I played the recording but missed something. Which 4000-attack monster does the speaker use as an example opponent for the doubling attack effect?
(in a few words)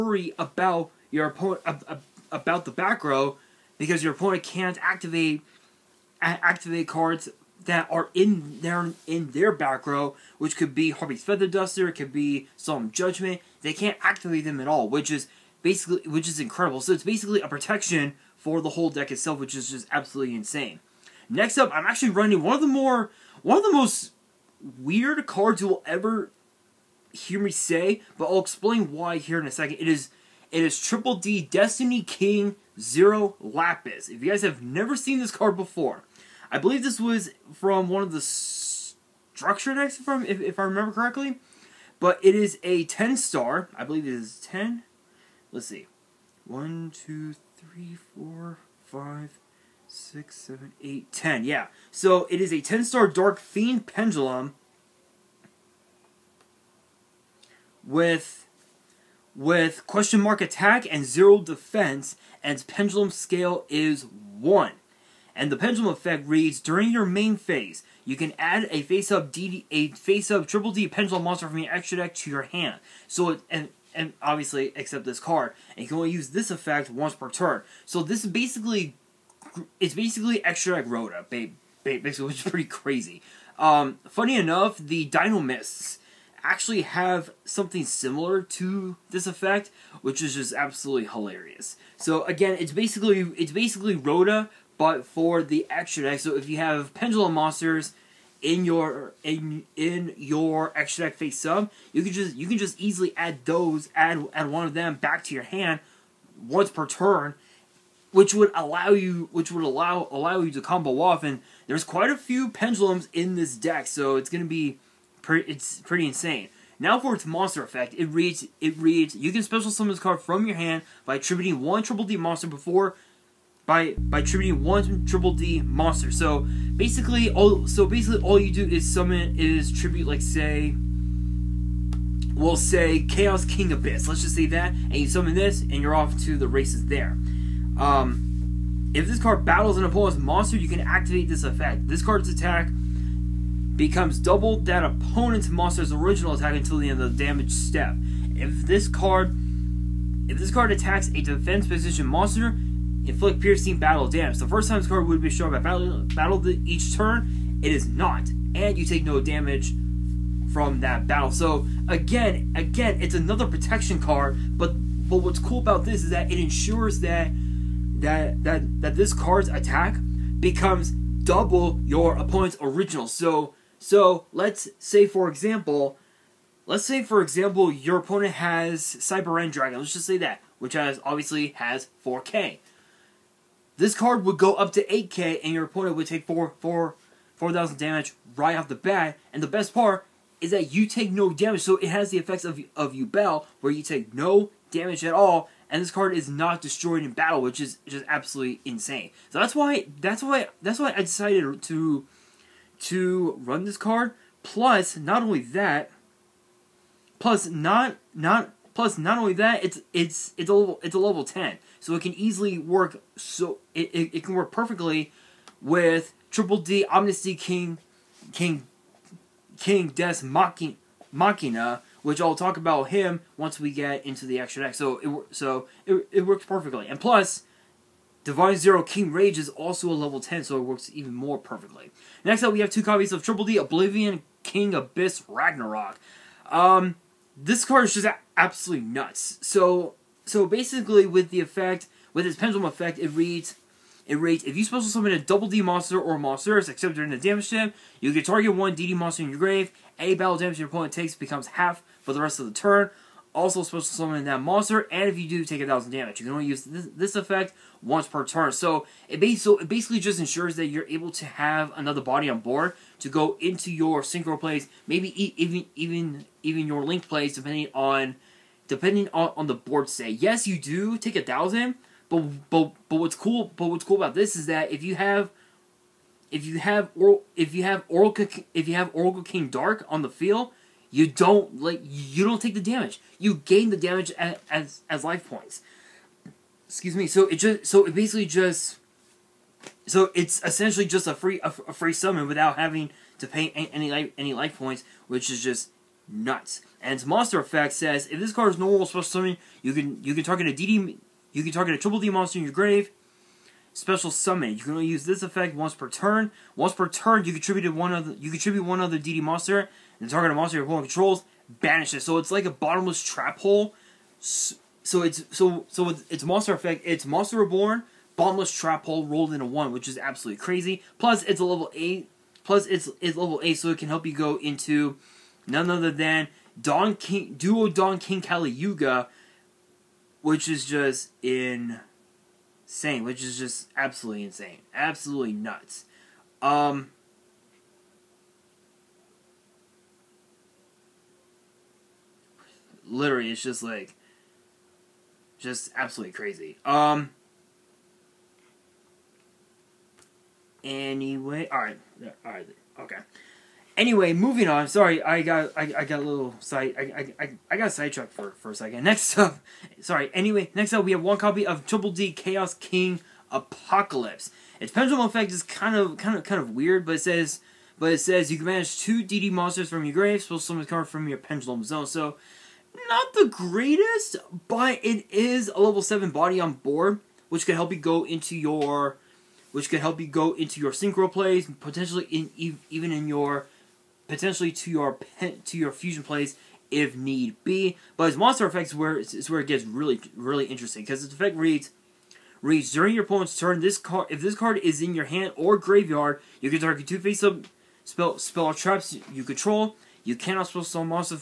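Cyber End Dragon.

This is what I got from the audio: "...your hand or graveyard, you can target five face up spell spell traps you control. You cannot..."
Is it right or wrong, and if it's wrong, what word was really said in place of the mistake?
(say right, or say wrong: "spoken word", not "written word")
wrong: "two", not "five".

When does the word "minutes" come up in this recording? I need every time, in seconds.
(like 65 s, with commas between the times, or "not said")
not said.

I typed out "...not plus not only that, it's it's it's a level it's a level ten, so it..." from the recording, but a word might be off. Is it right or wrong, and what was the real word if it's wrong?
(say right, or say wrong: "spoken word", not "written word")
right.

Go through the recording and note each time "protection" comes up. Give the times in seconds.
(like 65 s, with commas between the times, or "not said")
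17 s, 163 s.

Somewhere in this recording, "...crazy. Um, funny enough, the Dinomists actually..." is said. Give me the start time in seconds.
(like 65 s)
82 s.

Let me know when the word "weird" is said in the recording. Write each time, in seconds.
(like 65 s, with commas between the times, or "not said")
24 s, 366 s.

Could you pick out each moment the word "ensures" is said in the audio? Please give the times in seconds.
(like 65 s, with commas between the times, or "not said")
166 s, 260 s.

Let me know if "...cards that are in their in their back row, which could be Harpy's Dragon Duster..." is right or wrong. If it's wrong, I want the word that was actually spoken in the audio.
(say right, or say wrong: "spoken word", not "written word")
wrong: "Feather", not "Dragon".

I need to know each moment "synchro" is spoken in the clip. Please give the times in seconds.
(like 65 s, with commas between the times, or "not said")
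264 s, 380 s.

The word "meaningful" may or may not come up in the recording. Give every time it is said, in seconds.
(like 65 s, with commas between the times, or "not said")
not said.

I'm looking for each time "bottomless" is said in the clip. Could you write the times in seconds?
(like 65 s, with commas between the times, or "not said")
312 s, 318 s.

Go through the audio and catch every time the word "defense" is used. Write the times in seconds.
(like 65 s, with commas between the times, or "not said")
61 s, 151 s.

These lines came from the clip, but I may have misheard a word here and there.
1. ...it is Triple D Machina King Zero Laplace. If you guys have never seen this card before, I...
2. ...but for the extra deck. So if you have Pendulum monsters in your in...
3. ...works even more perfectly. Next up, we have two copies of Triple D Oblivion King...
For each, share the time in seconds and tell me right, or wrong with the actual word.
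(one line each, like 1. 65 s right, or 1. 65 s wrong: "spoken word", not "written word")
1. 30 s wrong: "Destiny", not "Machina"
2. 94 s right
3. 230 s right.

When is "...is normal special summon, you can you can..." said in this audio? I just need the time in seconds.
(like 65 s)
298 s.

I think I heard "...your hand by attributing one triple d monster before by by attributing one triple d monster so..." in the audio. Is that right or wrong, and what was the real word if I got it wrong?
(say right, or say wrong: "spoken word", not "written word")
right.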